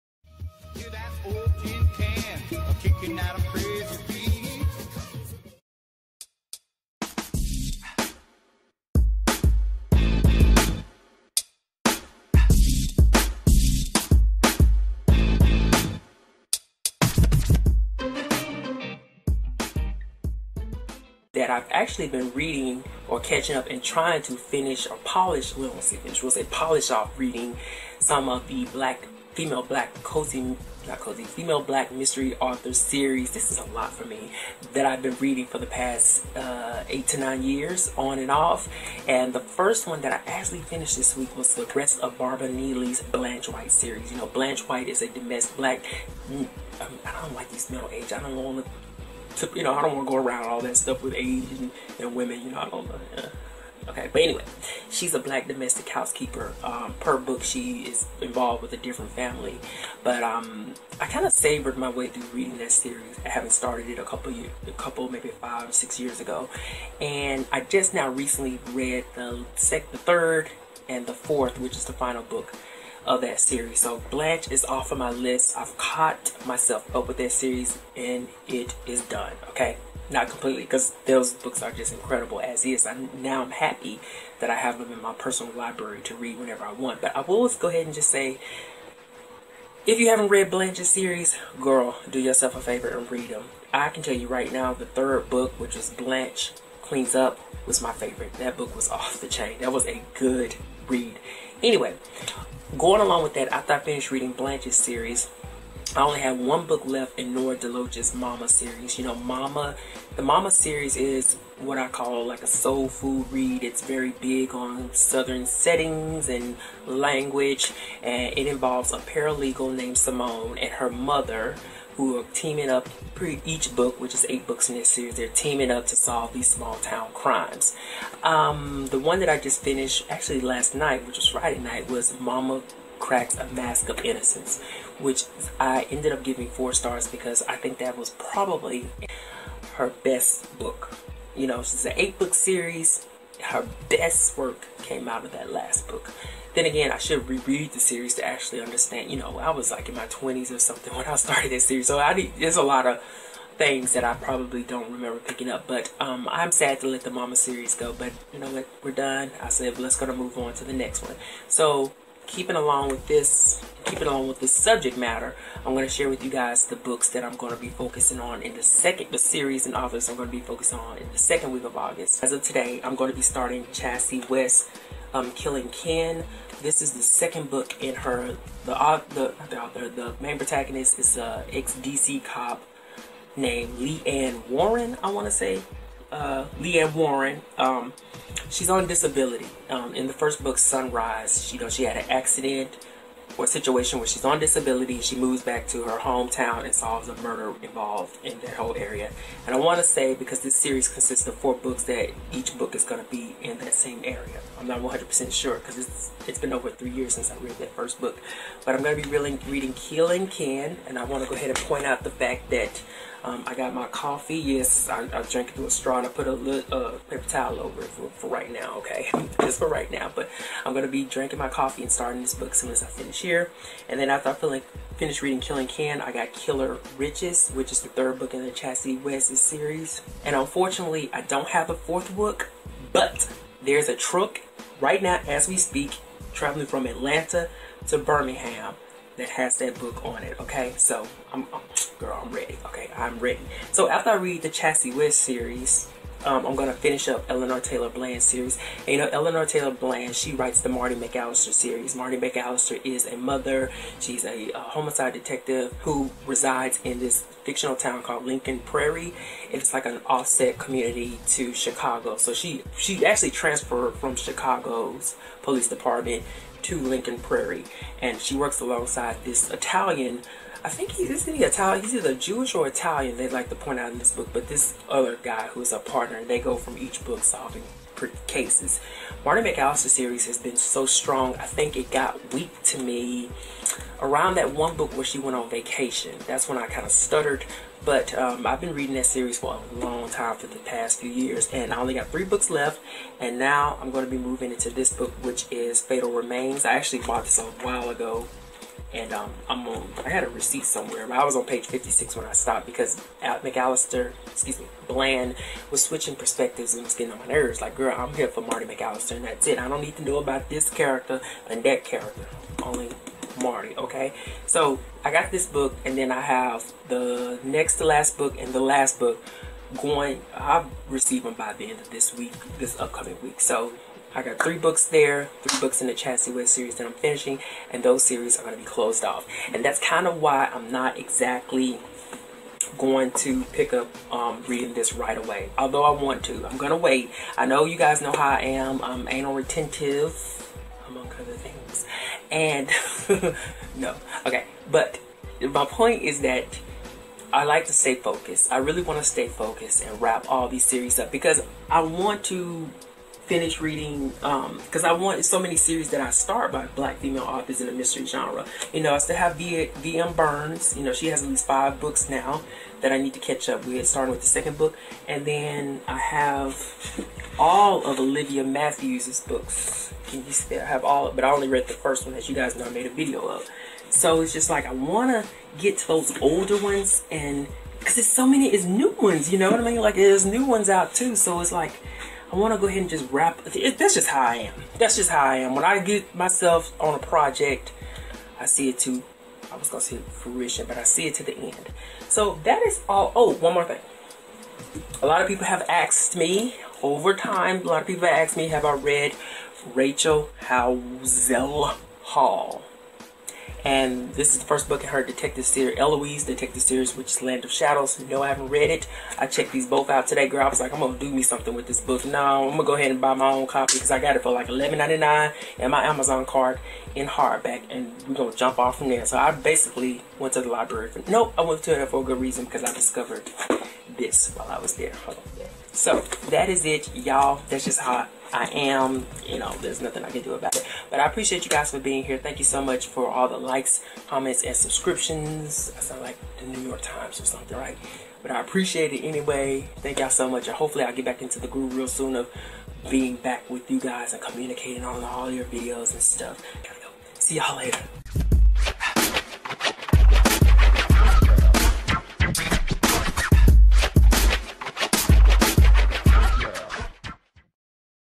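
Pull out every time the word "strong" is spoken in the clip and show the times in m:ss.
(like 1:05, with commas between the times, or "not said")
4:40.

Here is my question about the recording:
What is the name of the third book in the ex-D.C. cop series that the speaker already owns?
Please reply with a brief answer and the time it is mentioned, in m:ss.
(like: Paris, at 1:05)
Killer Riches, at 3:46.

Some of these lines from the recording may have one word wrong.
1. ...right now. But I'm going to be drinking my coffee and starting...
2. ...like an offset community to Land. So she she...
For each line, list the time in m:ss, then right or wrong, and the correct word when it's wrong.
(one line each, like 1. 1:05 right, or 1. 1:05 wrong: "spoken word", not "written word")
1. 3:39 right
2. 4:19 wrong: "Chicago", not "Land".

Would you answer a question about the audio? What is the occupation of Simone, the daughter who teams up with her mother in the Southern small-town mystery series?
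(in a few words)
Paralegal.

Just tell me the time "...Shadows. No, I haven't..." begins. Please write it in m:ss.
6:47.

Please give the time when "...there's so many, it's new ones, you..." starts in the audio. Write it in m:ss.
6:17.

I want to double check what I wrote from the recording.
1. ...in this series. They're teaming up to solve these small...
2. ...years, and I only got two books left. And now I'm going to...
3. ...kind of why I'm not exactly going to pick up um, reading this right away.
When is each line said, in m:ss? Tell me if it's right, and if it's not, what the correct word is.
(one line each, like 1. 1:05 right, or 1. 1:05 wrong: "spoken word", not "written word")
1. 2:04 right
2. 4:51 wrong: "three", not "two"
3. 5:29 right.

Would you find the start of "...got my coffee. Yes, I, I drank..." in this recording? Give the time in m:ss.
3:33.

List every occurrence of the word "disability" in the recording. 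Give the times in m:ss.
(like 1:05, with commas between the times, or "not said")
3:08, 3:14.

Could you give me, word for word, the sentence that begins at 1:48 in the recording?
You know, Mama, the Mama series is what I call like a soul food read.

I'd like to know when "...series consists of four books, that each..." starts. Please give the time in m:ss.
3:20.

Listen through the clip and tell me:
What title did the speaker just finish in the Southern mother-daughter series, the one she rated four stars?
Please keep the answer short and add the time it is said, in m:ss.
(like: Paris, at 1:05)
Mama Cracks a Mask of Innocence, at 2:12.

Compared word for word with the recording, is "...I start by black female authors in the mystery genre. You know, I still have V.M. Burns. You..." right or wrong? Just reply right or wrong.
right.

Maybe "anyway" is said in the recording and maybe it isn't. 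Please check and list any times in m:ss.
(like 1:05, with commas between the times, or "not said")
0:54, 1:41, 7:19.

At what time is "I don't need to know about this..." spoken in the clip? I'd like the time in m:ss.
5:09.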